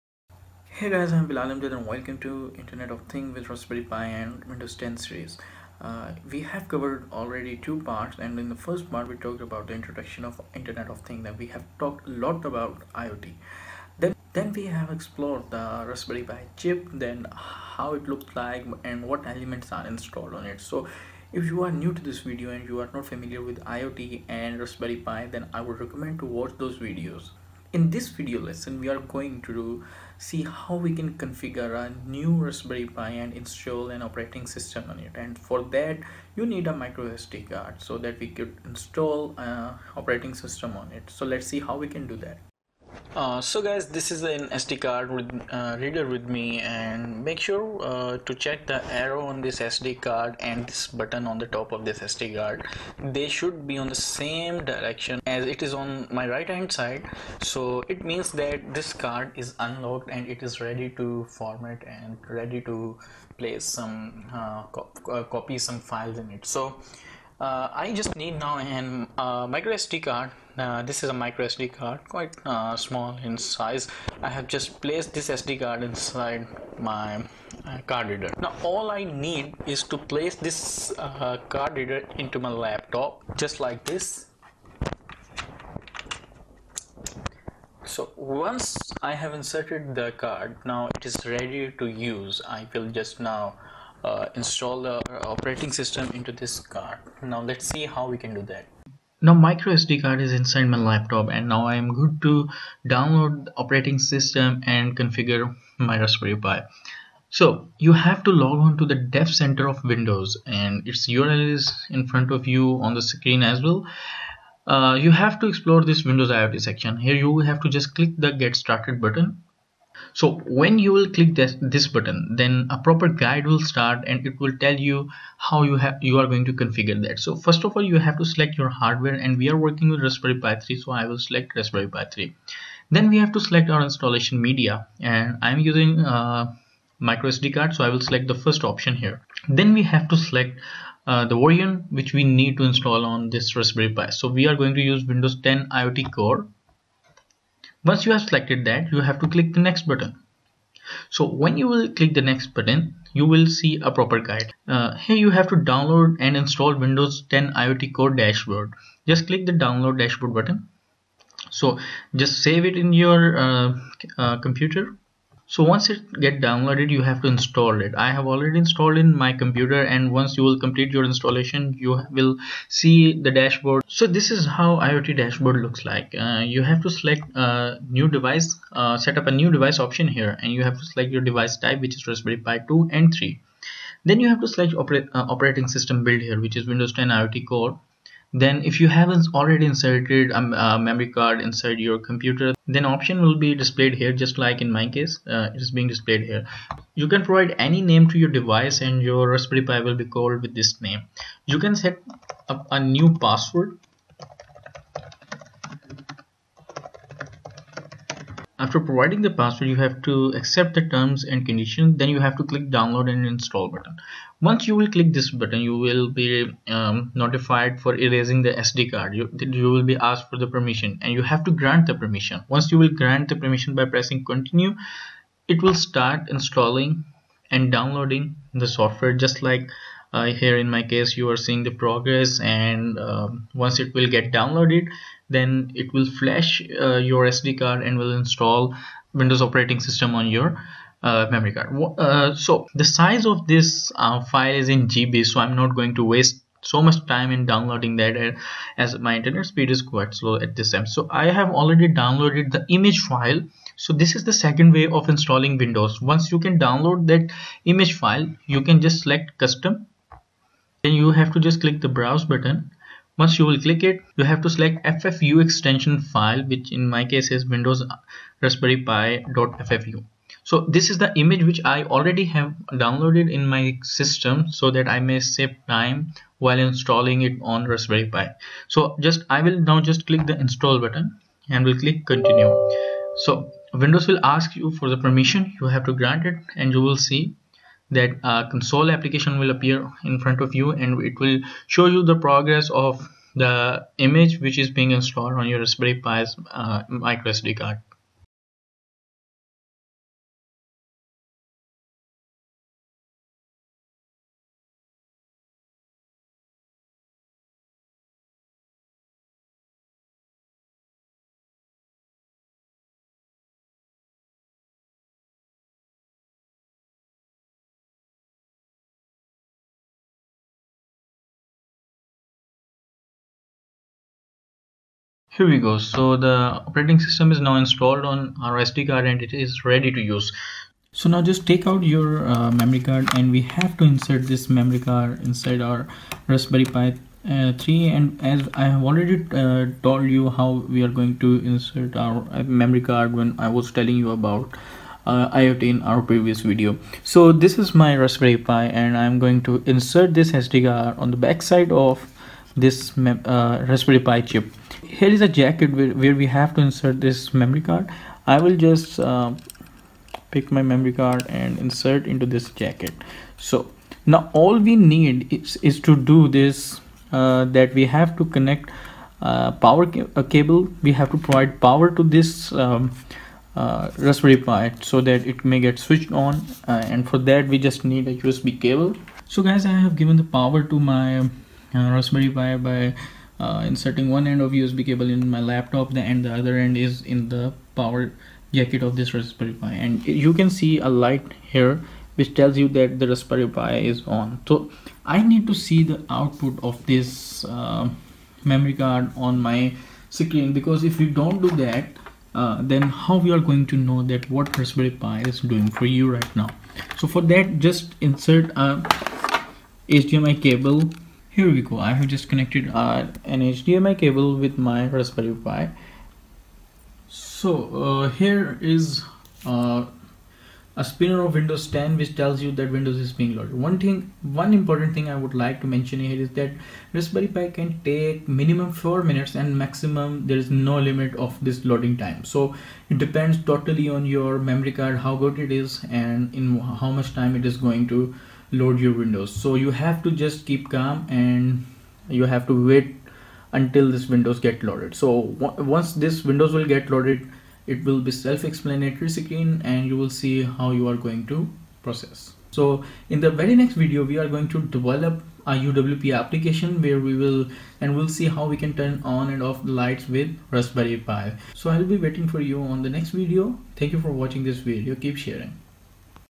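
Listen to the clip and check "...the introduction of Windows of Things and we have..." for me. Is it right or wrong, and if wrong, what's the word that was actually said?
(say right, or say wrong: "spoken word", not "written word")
wrong: "Internet", not "Windows".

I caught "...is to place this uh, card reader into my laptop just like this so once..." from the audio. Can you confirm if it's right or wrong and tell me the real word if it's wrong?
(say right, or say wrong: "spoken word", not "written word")
right.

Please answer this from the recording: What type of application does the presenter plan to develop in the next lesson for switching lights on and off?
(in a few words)
UWP application.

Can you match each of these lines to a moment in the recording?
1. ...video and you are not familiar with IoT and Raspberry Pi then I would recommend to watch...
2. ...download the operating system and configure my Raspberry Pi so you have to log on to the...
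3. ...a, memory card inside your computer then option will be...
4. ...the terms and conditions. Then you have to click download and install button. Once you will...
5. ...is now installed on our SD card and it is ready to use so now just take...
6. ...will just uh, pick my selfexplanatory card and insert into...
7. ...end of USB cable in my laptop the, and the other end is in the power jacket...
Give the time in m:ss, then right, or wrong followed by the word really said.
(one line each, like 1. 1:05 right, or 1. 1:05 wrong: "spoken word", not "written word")
1. 0:22 right
2. 1:42 right
3. 3:10 right
4. 3:30 right
5. 5:27 right
6. 5:58 wrong: "memory", not "selfexplanatory"
7. 6:24 right.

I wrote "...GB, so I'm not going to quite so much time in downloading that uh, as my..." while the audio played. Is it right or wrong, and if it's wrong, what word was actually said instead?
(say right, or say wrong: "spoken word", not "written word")
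wrong: "waste", not "quite".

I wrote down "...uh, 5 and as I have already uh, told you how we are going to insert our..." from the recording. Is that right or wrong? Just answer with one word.
wrong.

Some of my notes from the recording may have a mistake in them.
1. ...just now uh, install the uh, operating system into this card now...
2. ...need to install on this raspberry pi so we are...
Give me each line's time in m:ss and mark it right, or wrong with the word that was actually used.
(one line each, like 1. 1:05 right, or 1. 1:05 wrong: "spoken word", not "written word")
1. 1:32 right
2. 2:22 right.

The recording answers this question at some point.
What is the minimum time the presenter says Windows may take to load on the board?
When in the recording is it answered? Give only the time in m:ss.
7:08.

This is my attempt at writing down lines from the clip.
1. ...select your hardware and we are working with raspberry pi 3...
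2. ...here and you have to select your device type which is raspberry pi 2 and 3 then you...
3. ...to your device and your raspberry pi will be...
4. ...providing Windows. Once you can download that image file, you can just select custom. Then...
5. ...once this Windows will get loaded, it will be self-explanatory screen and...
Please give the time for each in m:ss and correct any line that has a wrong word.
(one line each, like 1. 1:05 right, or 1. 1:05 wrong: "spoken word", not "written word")
1. 2:08 right
2. 3:00 right
3. 3:18 right
4. 4:15 wrong: "installing", not "providing"
5. 7:25 right.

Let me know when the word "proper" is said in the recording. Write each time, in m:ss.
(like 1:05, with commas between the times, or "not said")
2:02, 2:33.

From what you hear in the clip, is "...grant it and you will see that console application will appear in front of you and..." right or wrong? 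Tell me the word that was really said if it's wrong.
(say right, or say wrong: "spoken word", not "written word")
right.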